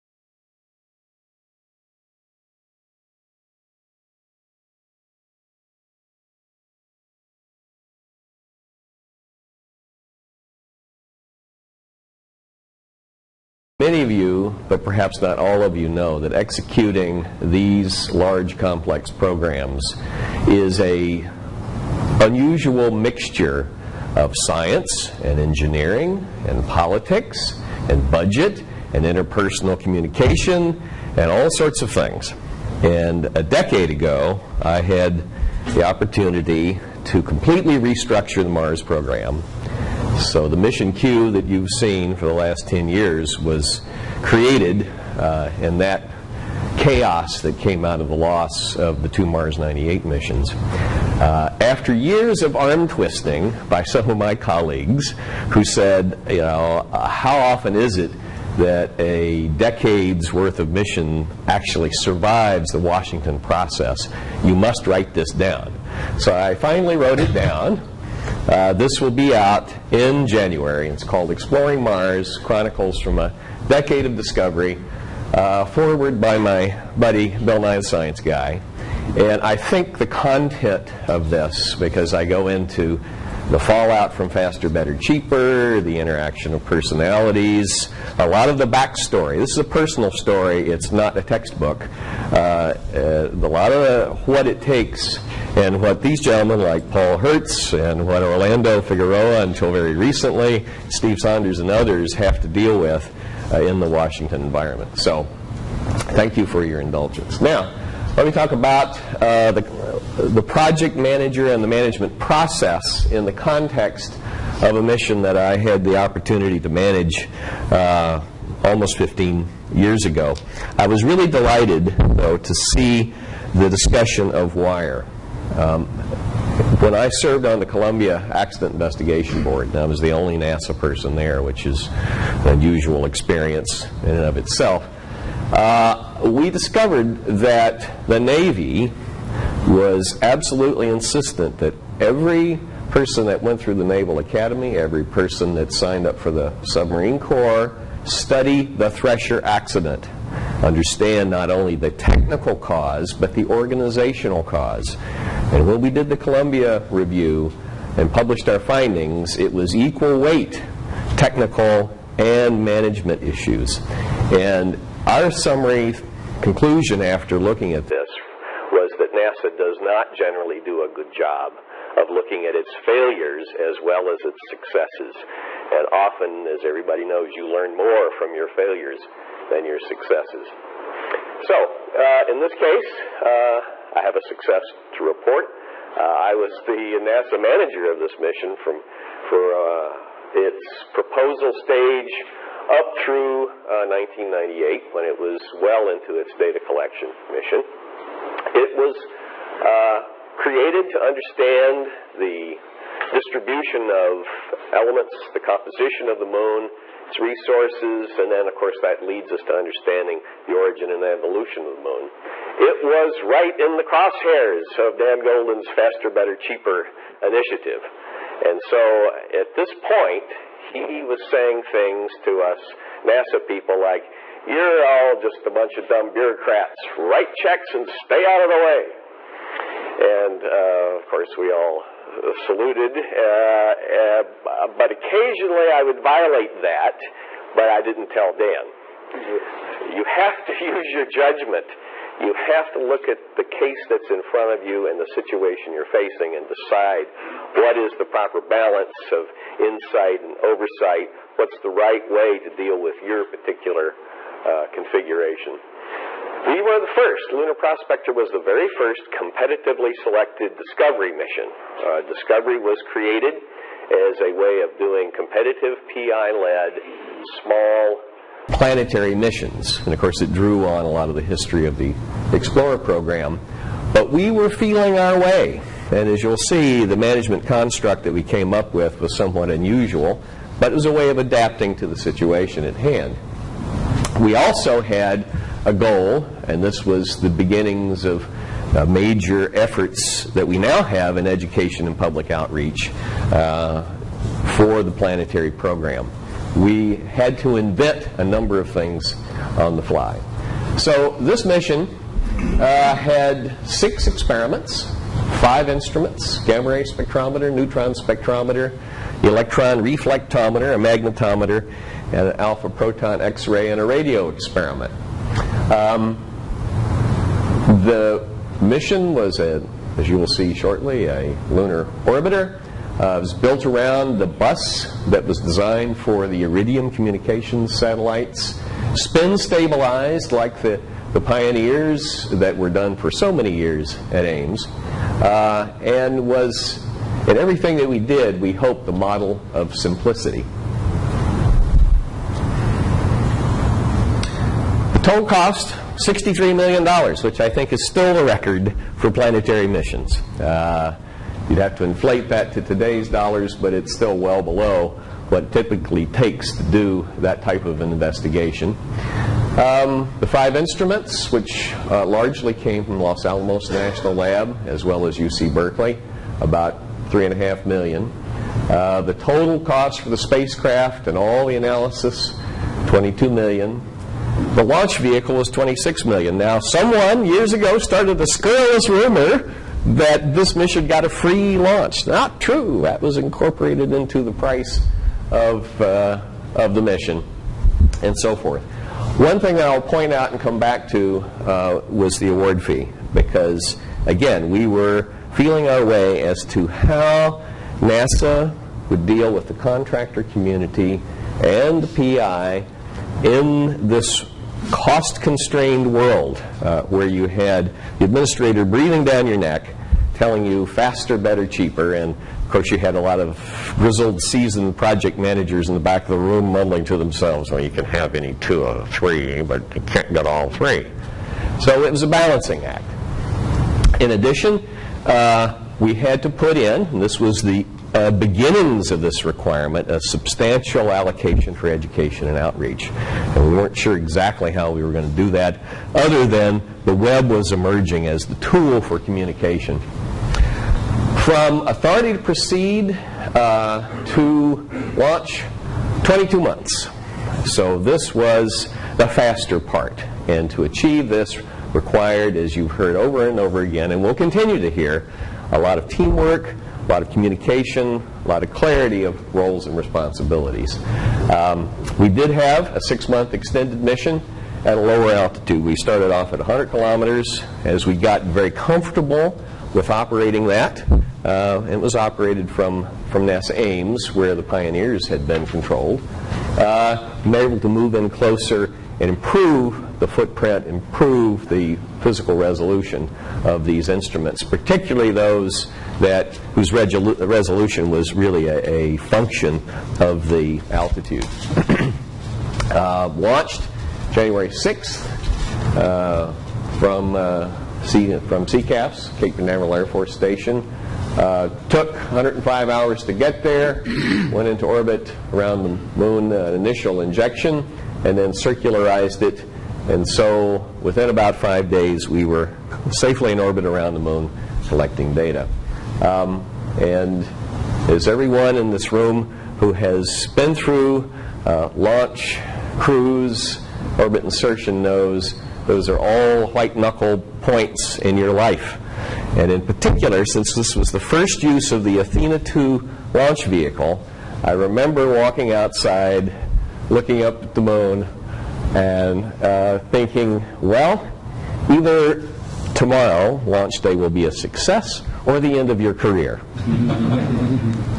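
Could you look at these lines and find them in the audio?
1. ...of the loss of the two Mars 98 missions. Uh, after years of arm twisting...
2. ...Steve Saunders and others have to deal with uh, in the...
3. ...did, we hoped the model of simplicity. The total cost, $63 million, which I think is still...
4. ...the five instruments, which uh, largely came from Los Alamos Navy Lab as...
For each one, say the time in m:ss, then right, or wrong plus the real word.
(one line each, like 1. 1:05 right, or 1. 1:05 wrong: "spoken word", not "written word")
1. 0:48 right
2. 1:40 right
3. 5:37 right
4. 6:00 wrong: "National", not "Navy".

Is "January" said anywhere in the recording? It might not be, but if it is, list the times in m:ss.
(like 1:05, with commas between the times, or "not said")
1:10, 8:14.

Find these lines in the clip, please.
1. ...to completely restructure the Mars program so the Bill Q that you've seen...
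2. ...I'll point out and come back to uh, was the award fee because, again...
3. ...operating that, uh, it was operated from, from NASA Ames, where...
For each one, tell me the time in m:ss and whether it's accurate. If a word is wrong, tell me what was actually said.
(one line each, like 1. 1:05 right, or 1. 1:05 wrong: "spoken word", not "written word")
1. 0:37 wrong: "Mission", not "Bill"
2. 6:29 right
3. 7:49 right.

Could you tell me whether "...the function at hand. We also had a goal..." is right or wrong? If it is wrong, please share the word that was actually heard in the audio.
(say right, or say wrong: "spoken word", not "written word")
wrong: "situation", not "function".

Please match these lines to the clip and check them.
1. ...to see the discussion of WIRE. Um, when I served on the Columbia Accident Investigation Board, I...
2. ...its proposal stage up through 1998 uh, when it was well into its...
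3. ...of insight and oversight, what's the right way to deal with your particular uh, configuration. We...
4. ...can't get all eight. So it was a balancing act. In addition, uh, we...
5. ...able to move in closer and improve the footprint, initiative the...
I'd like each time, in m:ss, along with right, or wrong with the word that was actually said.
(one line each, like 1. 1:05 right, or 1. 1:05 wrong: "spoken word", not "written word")
1. 2:02 right
2. 3:10 right
3. 4:09 right
4. 6:59 wrong: "three", not "eight"
5. 7:57 wrong: "improve", not "initiative".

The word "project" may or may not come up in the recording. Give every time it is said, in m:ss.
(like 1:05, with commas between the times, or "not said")
1:50, 6:54.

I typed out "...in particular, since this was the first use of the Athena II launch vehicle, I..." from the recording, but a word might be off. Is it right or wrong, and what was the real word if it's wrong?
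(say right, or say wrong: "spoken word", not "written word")
right.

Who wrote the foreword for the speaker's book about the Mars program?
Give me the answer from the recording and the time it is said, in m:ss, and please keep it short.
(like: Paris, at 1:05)
Bill Nye, at 1:17.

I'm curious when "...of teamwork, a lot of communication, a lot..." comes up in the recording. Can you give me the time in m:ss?
7:35.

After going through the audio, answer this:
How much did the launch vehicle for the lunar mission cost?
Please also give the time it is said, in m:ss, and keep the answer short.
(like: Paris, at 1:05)
26 million, at 6:15.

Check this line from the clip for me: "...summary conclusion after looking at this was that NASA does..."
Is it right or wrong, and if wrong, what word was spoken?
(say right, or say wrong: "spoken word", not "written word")
right.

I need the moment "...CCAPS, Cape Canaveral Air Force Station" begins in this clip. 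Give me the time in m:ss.
8:18.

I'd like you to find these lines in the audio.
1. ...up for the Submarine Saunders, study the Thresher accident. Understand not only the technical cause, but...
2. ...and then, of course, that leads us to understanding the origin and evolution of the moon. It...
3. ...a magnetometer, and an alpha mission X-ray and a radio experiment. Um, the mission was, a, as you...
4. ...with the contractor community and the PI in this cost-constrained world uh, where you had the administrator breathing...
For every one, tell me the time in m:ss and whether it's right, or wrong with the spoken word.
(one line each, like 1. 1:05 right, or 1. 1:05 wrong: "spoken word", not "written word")
1. 2:26 wrong: "Corps", not "Saunders"
2. 3:28 right
3. 5:10 wrong: "proton", not "mission"
4. 6:39 right.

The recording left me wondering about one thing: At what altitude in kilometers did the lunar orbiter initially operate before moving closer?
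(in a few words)
100 kilometers.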